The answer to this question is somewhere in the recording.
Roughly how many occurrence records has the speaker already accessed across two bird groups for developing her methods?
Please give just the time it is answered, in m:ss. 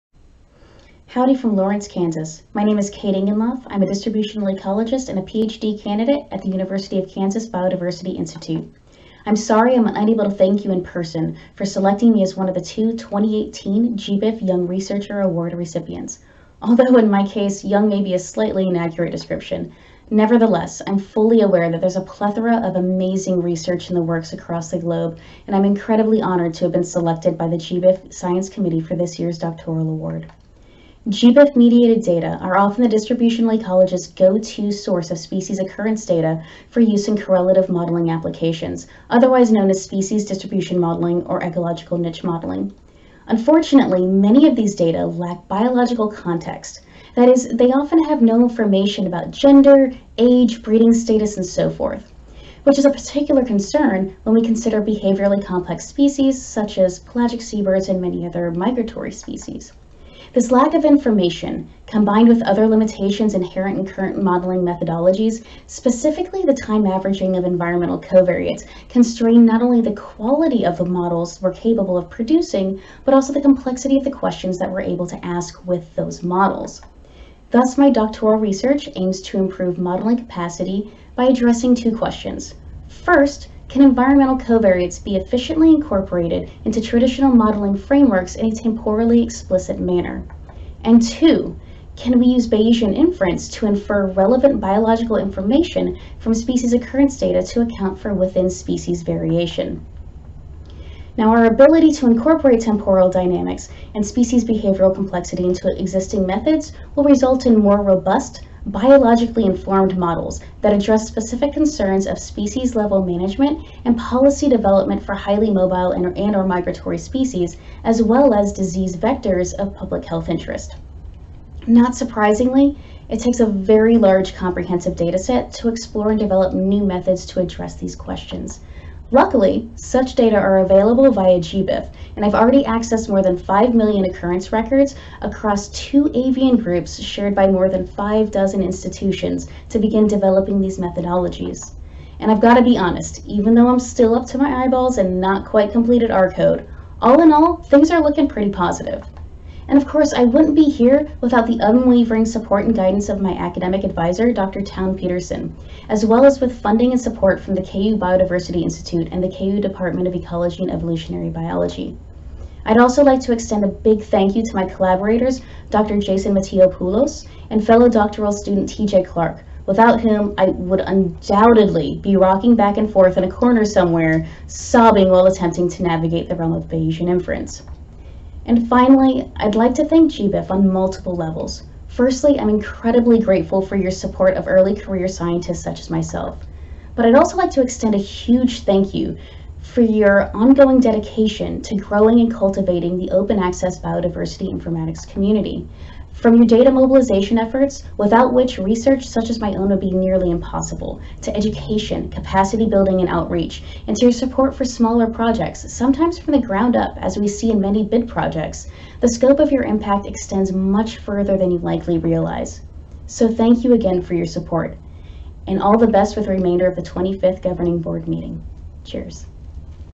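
2:13.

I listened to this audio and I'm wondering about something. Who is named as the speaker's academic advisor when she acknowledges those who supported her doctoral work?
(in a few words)
Dr. Town Peterson.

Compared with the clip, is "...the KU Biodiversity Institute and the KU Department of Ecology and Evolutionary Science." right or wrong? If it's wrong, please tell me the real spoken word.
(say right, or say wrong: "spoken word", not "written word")
wrong: "Biology", not "Science".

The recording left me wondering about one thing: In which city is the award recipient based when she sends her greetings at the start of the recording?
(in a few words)
Lawrence, Kansas.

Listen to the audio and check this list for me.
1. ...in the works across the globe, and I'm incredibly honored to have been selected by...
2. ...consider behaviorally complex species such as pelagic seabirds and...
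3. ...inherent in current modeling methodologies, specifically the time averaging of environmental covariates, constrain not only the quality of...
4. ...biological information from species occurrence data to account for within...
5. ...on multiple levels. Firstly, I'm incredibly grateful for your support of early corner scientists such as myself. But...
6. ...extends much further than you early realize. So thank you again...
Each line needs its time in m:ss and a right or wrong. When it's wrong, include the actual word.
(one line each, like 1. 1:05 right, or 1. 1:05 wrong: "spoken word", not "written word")
1. 0:23 right
2. 0:54 right
3. 1:03 right
4. 1:34 right
5. 3:00 wrong: "career", not "corner"
6. 3:30 wrong: "likely", not "early".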